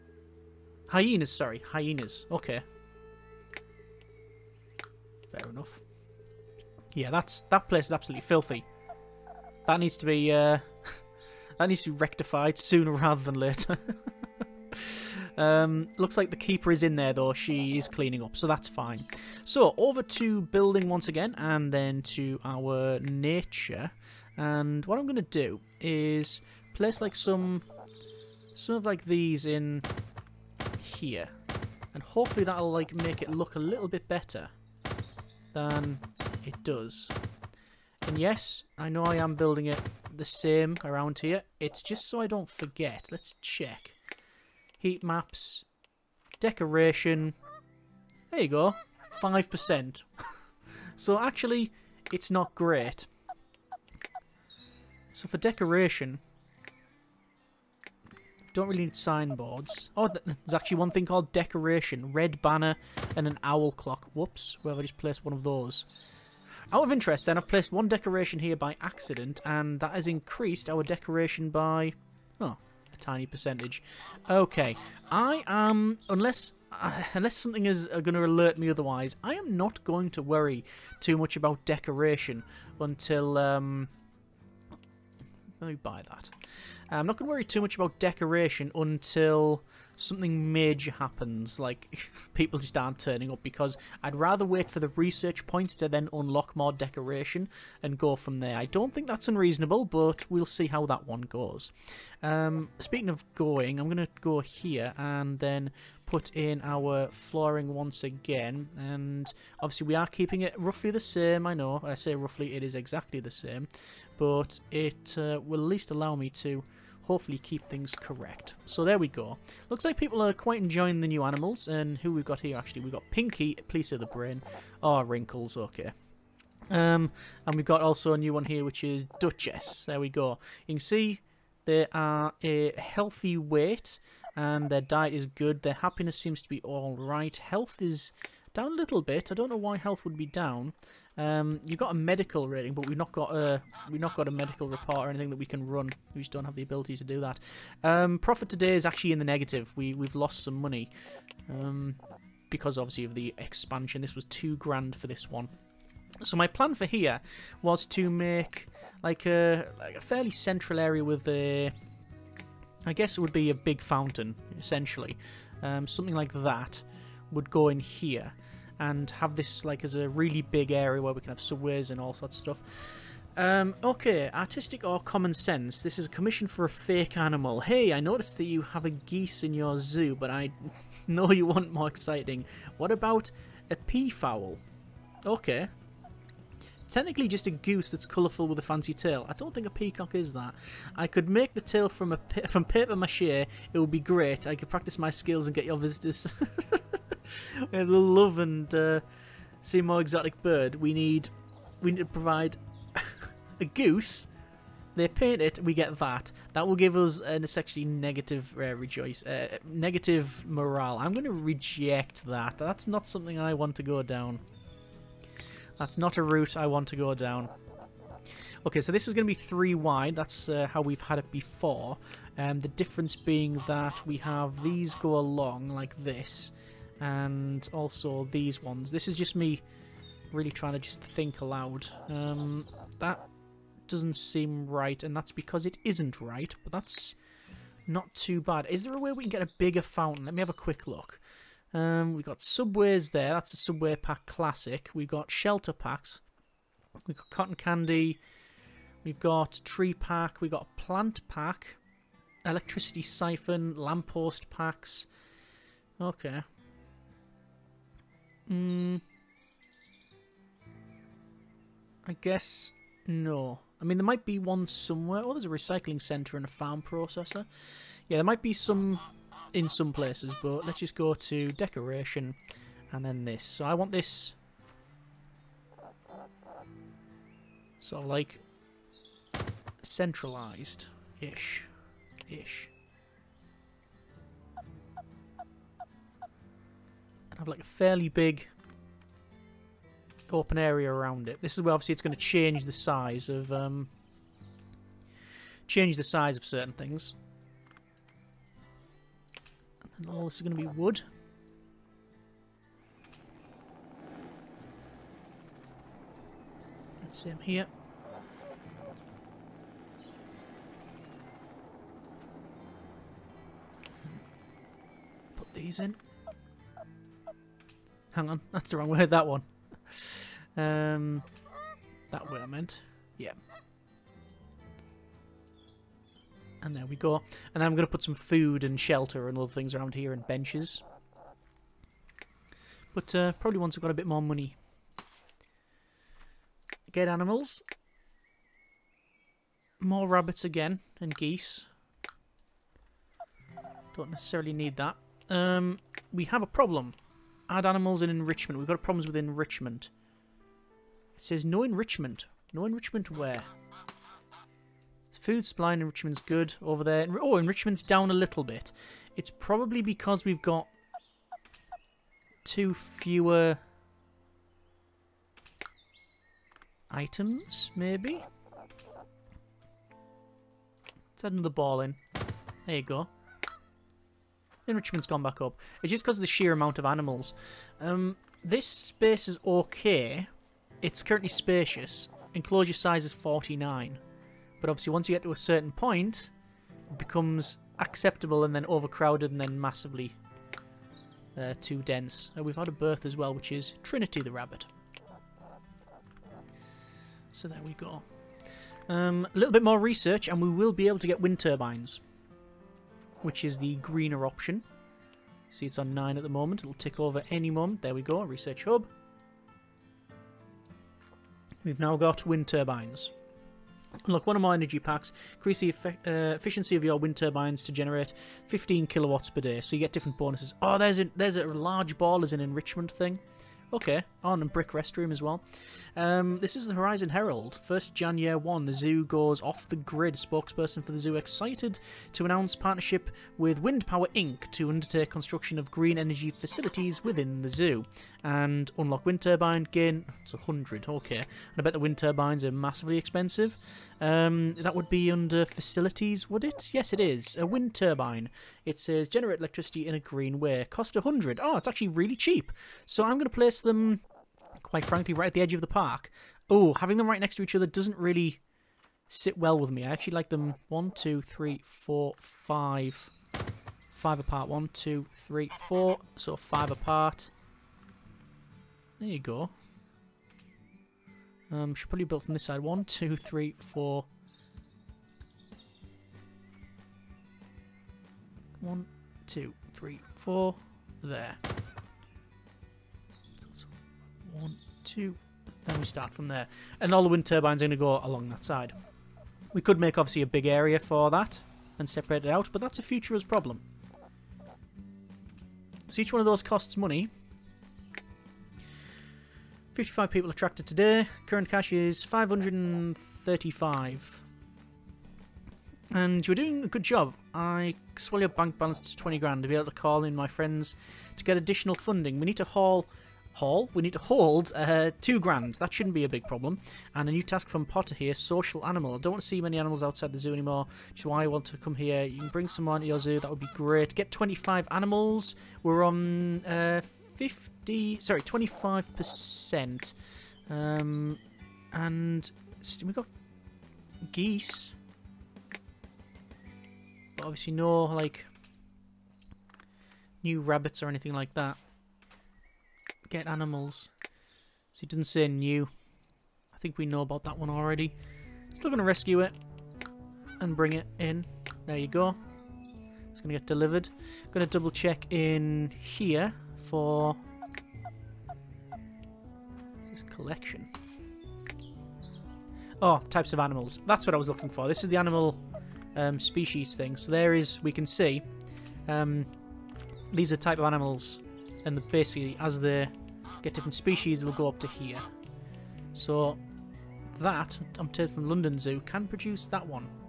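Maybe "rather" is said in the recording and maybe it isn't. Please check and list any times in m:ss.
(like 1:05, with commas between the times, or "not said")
0:12, 1:34.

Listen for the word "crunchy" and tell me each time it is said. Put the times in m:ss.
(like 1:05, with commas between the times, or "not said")
not said.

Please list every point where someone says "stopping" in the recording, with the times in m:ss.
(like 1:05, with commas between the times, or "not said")
not said.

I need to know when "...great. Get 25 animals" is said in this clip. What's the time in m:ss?
8:43.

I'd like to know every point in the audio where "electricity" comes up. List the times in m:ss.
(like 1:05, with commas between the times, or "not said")
4:12, 7:29.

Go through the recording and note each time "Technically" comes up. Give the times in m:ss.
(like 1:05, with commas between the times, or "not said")
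3:06.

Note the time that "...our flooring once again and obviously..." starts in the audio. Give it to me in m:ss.
1:46.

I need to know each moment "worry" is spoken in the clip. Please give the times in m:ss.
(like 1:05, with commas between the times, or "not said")
1:20, 1:27.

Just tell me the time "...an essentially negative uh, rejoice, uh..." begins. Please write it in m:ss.
3:27.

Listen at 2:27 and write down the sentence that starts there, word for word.
Um, profit today is actually in the negative.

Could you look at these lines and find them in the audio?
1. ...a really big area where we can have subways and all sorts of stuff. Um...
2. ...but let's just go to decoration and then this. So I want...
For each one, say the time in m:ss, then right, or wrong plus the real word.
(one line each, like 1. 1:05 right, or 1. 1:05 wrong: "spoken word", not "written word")
1. 2:49 right
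2. 4:30 right.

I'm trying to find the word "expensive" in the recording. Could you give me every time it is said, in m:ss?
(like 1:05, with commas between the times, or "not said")
7:22.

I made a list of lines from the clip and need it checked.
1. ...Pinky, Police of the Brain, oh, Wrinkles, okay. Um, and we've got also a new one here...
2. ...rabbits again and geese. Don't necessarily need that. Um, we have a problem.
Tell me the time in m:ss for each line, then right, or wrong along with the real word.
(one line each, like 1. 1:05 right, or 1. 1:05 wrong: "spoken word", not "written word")
1. 2:03 right
2. 5:40 right.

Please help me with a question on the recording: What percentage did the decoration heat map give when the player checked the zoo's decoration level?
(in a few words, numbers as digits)
5%.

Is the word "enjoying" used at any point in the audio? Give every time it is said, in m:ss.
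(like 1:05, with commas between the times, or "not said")
2:00.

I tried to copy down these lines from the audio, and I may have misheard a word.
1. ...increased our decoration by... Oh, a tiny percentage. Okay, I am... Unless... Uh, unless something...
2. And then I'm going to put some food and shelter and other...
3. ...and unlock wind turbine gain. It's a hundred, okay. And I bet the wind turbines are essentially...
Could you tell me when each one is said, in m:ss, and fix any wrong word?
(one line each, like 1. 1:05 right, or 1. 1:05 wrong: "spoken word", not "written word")
1. 1:10 right
2. 5:27 right
3. 7:18 wrong: "massively", not "essentially".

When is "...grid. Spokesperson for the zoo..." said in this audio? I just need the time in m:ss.
7:09.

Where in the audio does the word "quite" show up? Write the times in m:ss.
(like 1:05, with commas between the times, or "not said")
2:00, 7:34.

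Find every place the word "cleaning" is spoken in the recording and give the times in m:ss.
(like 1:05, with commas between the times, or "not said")
0:17.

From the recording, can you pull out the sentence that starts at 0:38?
And yes, I know I am building it the same around here.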